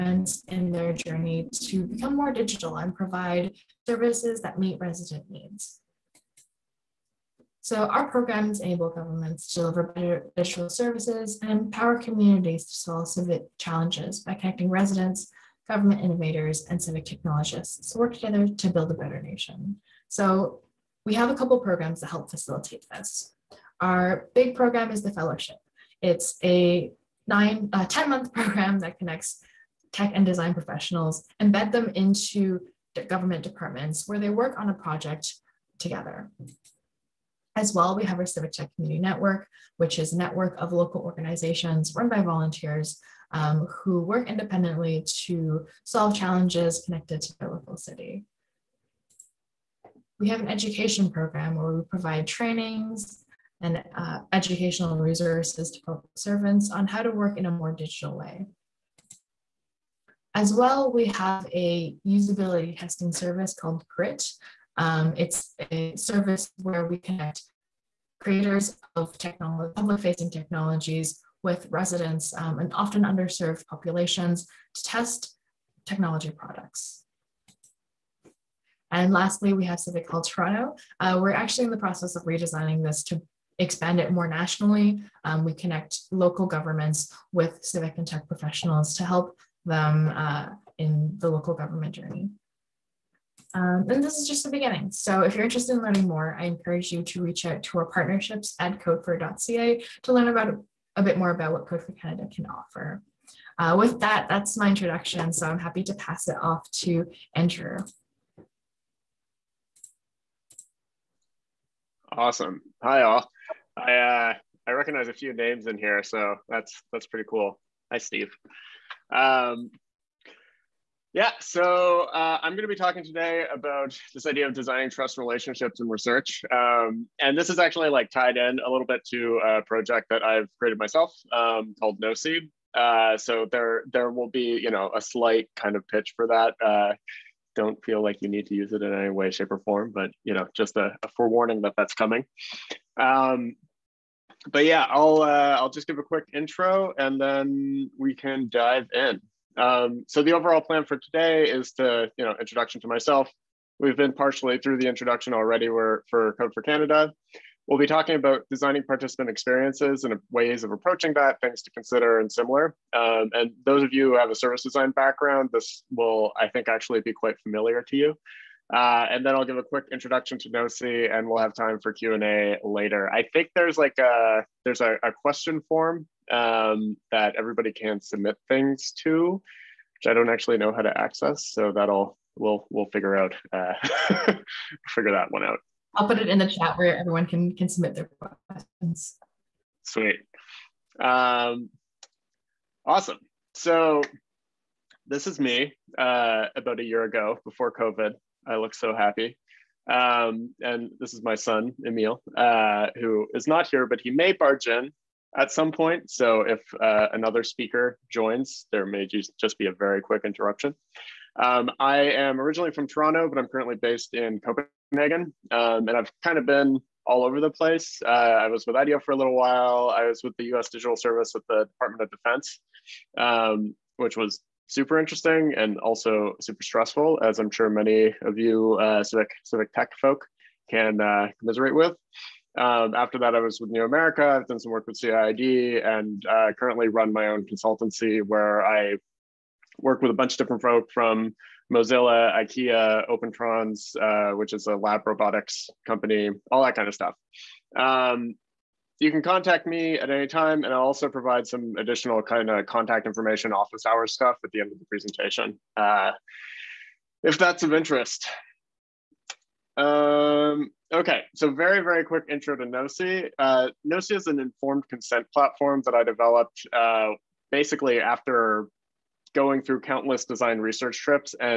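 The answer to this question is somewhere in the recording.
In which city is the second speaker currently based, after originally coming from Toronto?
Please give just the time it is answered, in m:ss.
3:34.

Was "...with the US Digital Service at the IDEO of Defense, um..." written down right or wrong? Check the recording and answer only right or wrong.
wrong.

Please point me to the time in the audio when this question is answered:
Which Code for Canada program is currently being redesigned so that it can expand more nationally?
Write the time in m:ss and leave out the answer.
1:19.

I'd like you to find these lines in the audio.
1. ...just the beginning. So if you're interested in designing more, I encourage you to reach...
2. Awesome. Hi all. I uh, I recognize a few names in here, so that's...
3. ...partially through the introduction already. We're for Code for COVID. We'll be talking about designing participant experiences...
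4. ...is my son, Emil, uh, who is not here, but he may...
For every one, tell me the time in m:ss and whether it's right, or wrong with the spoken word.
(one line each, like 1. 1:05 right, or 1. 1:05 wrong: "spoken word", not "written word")
1. 1:34 wrong: "learning", not "designing"
2. 1:52 right
3. 2:34 wrong: "Canada", not "COVID"
4. 3:21 right.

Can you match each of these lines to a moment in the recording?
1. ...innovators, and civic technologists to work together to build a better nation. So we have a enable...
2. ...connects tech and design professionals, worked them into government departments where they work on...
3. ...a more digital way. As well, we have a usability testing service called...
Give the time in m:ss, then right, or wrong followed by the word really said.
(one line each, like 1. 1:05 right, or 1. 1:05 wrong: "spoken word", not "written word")
1. 0:16 wrong: "couple", not "enable"
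2. 0:28 wrong: "embed", not "worked"
3. 0:57 right.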